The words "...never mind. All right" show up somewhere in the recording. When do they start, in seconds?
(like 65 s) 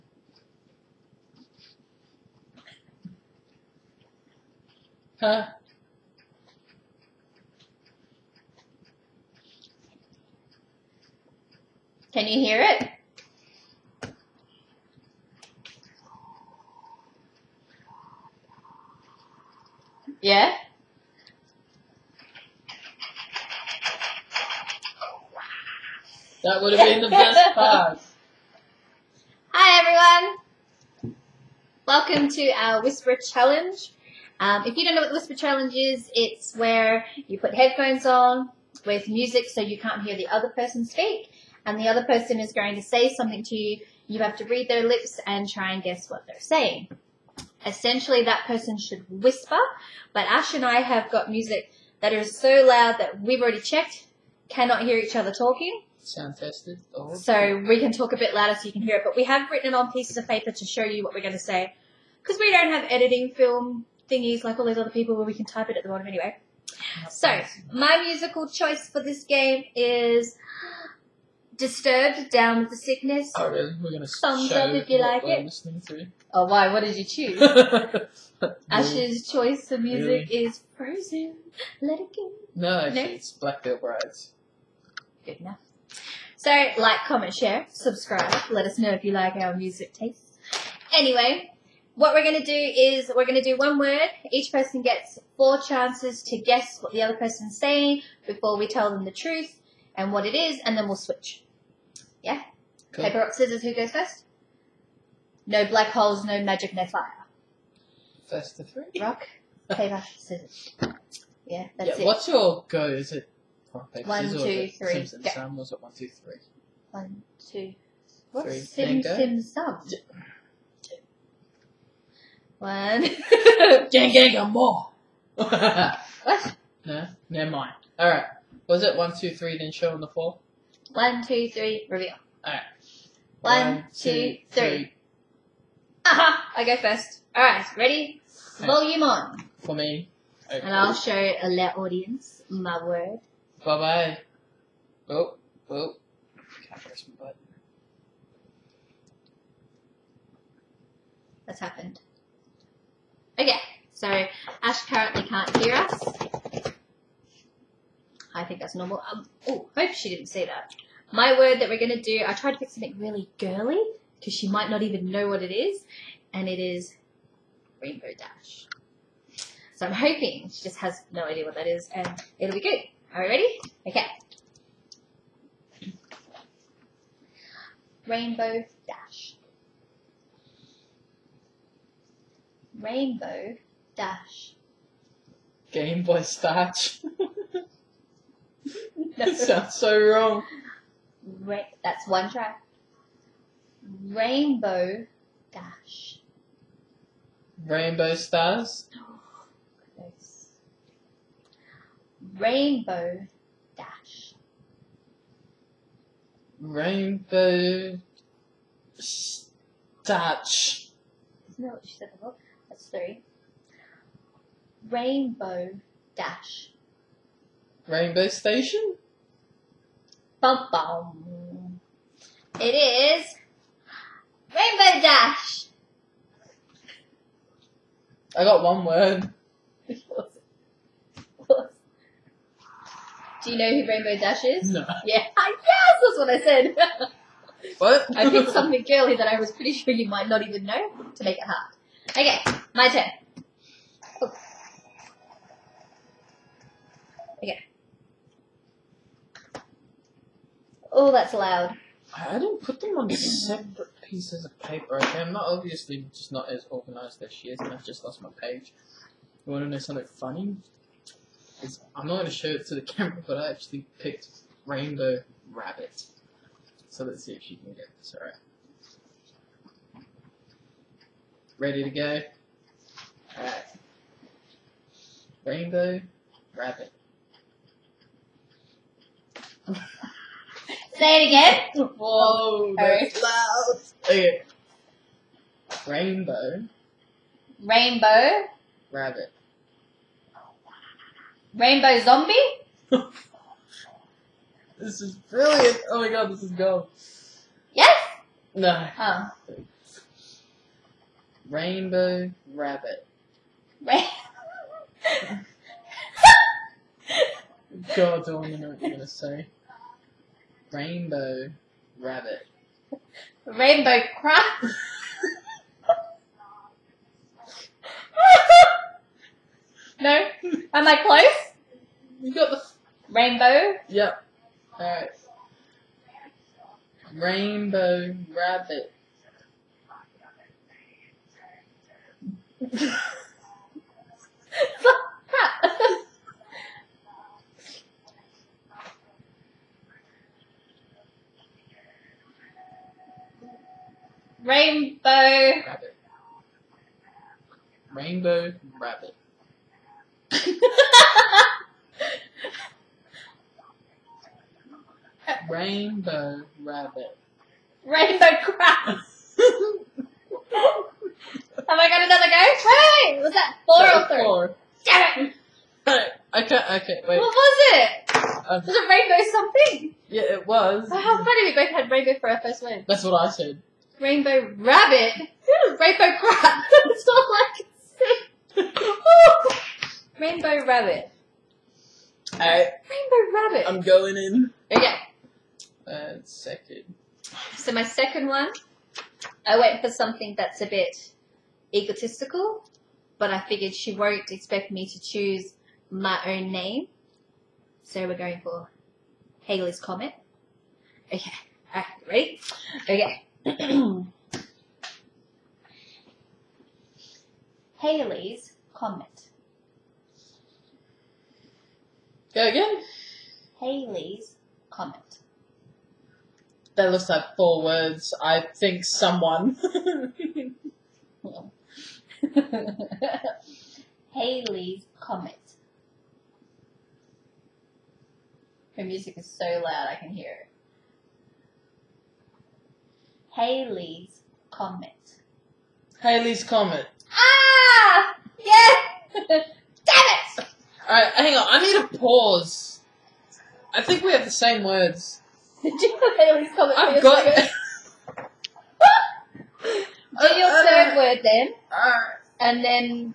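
127 s.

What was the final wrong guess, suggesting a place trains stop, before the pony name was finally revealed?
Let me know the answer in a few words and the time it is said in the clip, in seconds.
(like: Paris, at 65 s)
Rainbow Station, at 217 s.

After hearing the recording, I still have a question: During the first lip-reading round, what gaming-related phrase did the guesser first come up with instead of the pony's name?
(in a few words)
Game Boy Stash.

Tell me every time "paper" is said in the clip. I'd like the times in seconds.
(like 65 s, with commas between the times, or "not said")
60 s, 103 s, 109 s, 113 s, 254 s.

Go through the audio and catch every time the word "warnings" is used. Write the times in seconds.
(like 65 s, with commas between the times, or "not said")
not said.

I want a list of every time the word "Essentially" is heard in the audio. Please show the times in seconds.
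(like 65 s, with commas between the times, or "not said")
47 s.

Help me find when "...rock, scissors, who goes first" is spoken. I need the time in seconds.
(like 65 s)
103 s.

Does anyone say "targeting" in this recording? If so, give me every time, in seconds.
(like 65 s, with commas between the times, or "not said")
not said.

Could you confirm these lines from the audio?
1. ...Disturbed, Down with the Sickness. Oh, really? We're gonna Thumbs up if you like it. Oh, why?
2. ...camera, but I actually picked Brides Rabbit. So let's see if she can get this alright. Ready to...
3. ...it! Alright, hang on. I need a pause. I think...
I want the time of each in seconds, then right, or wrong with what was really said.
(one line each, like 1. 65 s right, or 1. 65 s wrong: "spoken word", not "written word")
1. 71 s right
2. 262 s wrong: "Rainbow", not "Brides"
3. 439 s right.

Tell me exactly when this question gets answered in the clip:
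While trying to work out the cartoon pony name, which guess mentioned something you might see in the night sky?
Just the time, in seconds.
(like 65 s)
197 s.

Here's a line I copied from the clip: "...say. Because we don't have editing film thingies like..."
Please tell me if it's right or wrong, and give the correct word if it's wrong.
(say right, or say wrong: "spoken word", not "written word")
right.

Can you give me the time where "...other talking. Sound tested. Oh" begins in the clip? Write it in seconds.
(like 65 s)
55 s.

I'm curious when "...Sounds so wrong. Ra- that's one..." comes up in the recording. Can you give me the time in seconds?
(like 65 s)
189 s.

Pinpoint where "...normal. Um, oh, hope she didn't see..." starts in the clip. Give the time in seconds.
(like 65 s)
158 s.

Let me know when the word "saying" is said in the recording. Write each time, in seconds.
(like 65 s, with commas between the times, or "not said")
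46 s, 97 s.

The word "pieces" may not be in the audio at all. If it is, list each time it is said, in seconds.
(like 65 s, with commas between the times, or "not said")
59 s, 254 s.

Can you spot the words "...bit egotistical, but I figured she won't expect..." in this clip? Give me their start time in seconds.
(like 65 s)
390 s.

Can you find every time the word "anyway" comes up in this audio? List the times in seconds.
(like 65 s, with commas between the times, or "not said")
66 s, 90 s.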